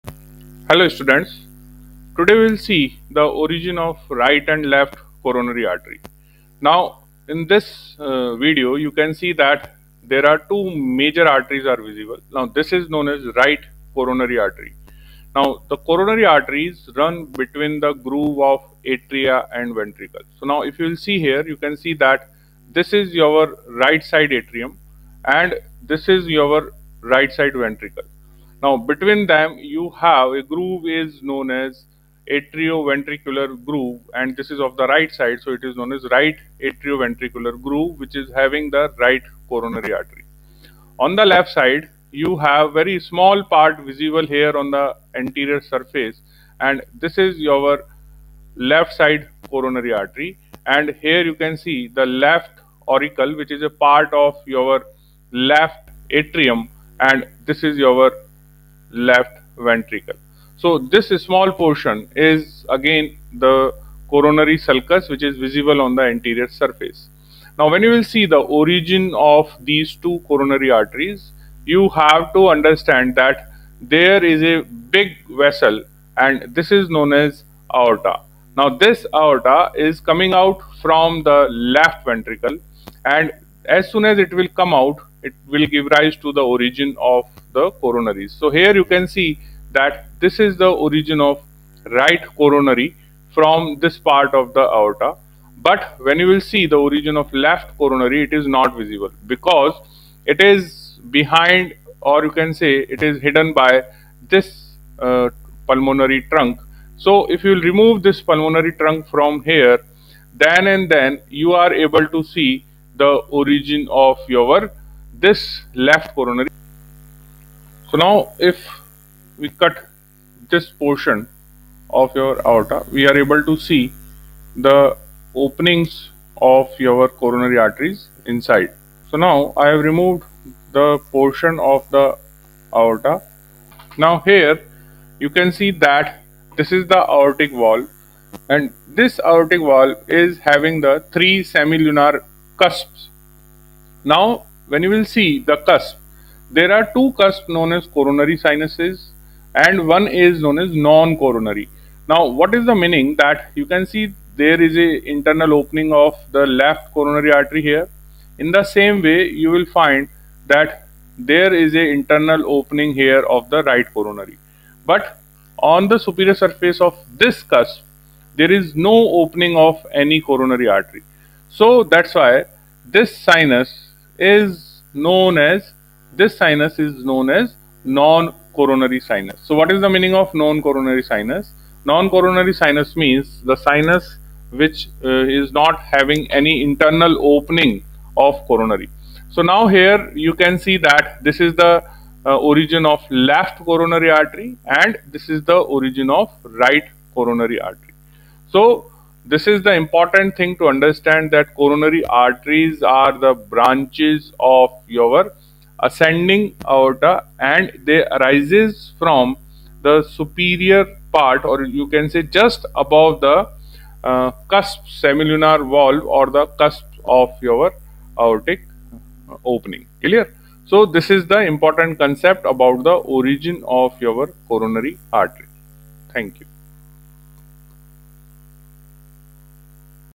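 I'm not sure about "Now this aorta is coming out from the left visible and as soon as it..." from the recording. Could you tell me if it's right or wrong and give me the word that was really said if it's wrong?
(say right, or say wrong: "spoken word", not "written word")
wrong: "ventricle", not "visible".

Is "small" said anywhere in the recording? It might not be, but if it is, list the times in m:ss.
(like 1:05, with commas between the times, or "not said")
0:42, 1:01.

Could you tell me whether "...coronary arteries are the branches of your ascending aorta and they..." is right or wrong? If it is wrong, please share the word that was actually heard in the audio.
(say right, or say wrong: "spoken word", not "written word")
right.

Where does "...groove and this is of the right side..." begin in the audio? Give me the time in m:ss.
0:33.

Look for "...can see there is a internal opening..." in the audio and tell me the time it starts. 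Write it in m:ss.
2:33.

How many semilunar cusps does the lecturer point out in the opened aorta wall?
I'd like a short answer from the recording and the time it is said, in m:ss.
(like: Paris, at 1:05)
3, at 2:21.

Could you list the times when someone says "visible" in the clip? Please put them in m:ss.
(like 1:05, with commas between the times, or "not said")
0:11, 0:43, 1:05, 1:38.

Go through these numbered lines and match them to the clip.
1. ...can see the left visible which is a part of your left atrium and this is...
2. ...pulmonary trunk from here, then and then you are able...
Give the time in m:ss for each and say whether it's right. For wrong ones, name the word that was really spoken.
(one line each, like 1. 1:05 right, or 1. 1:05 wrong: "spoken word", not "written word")
1. 0:51 wrong: "auricle", not "visible"
2. 1:48 right.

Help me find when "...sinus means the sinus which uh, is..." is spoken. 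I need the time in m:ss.
3:02.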